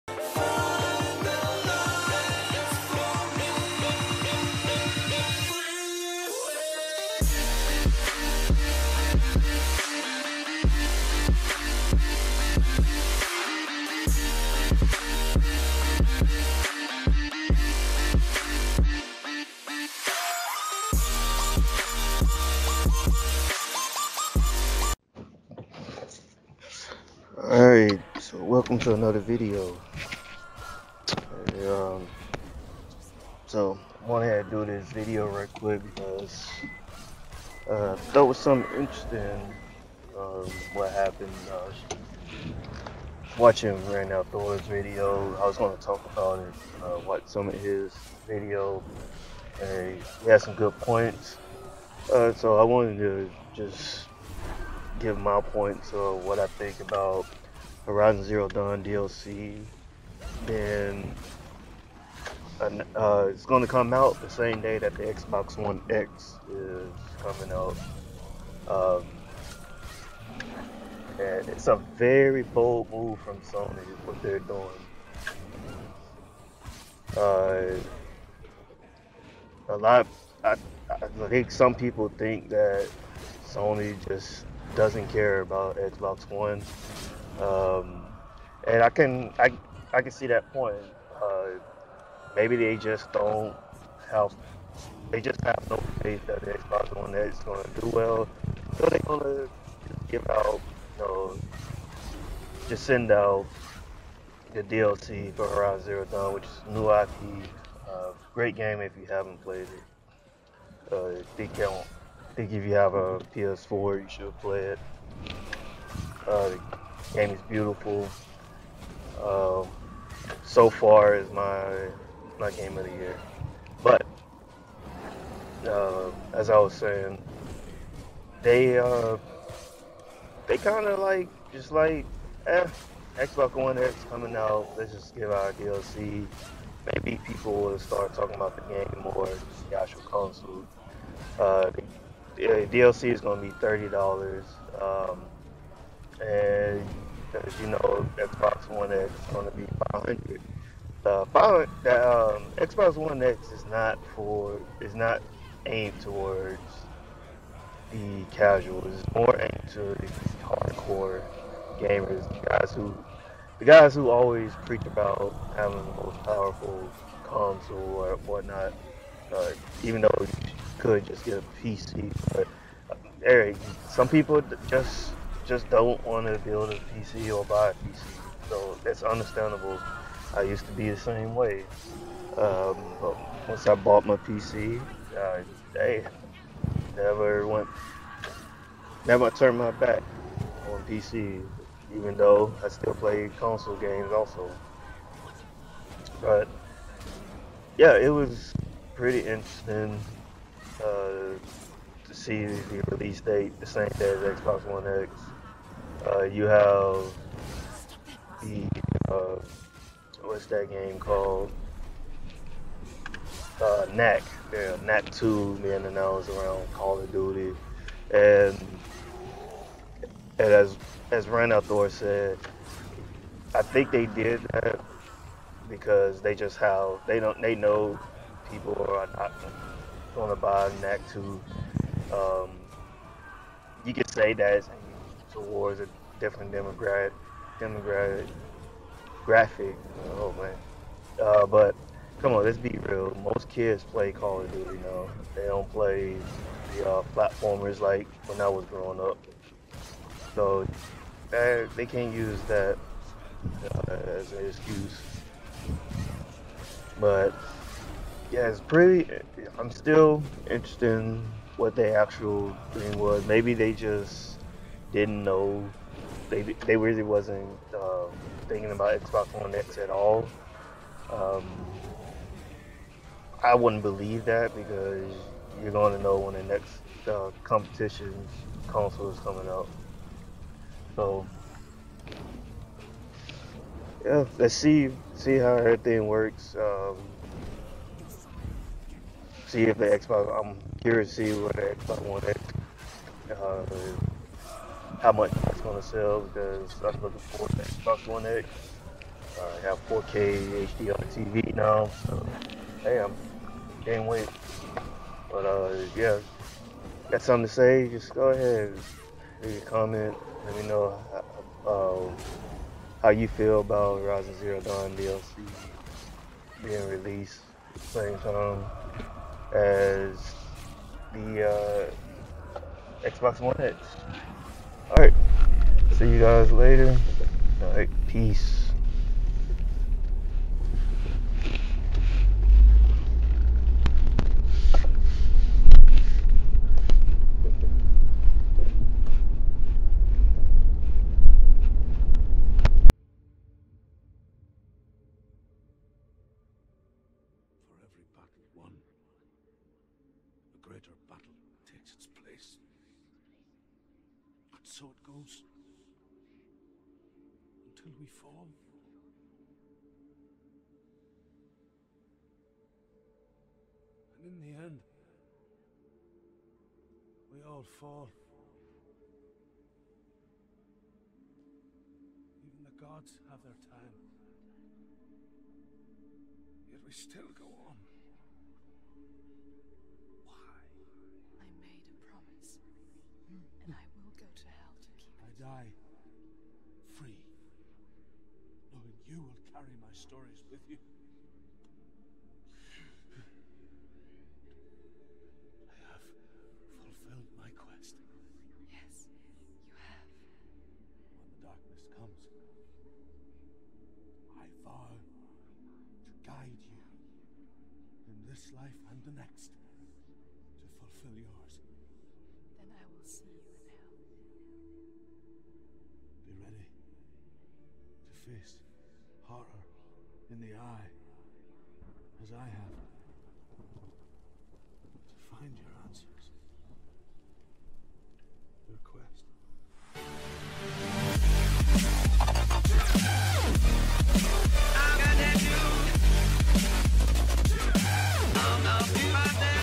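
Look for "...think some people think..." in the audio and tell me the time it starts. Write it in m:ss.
1:21.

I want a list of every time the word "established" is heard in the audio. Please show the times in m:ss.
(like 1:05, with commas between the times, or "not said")
not said.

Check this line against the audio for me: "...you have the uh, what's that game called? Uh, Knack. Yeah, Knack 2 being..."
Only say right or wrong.
right.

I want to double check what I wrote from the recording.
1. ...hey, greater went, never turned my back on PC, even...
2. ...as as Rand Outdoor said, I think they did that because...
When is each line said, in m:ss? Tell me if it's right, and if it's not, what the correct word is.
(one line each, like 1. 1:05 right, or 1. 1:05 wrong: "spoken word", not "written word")
1. 3:05 wrong: "never", not "greater"
2. 3:40 right.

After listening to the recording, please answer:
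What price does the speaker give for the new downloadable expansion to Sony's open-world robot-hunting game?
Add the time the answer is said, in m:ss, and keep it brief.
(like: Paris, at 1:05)
$30, at 2:23.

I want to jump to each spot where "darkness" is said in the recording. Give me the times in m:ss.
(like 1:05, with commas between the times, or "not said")
6:41.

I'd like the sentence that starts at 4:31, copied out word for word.
Um, I wouldn't believe that because you're going to know when the next uh, competition console is coming out.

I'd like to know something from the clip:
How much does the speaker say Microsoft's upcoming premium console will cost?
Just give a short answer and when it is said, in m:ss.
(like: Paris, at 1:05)
$500, at 2:29.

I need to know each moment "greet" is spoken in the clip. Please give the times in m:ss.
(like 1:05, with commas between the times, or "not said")
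not said.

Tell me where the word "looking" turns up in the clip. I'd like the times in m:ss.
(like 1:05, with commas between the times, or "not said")
4:57.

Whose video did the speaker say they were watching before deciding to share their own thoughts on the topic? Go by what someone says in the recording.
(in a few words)
Ran Outdoors.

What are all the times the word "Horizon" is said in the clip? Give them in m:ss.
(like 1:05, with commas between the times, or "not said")
0:57, 1:45, 5:13.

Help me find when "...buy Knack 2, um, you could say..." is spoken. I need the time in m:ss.
3:50.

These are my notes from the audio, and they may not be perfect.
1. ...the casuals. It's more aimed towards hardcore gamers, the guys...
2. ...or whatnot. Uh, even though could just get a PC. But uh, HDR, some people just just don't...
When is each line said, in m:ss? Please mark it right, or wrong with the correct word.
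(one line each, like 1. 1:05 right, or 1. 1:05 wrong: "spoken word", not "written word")
1. 2:37 right
2. 2:47 wrong: "Eric", not "HDR".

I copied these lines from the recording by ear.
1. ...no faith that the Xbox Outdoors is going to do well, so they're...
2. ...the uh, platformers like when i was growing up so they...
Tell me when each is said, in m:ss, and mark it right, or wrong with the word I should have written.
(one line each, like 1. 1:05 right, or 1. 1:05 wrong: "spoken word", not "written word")
1. 1:35 wrong: "One", not "Outdoors"
2. 4:06 right.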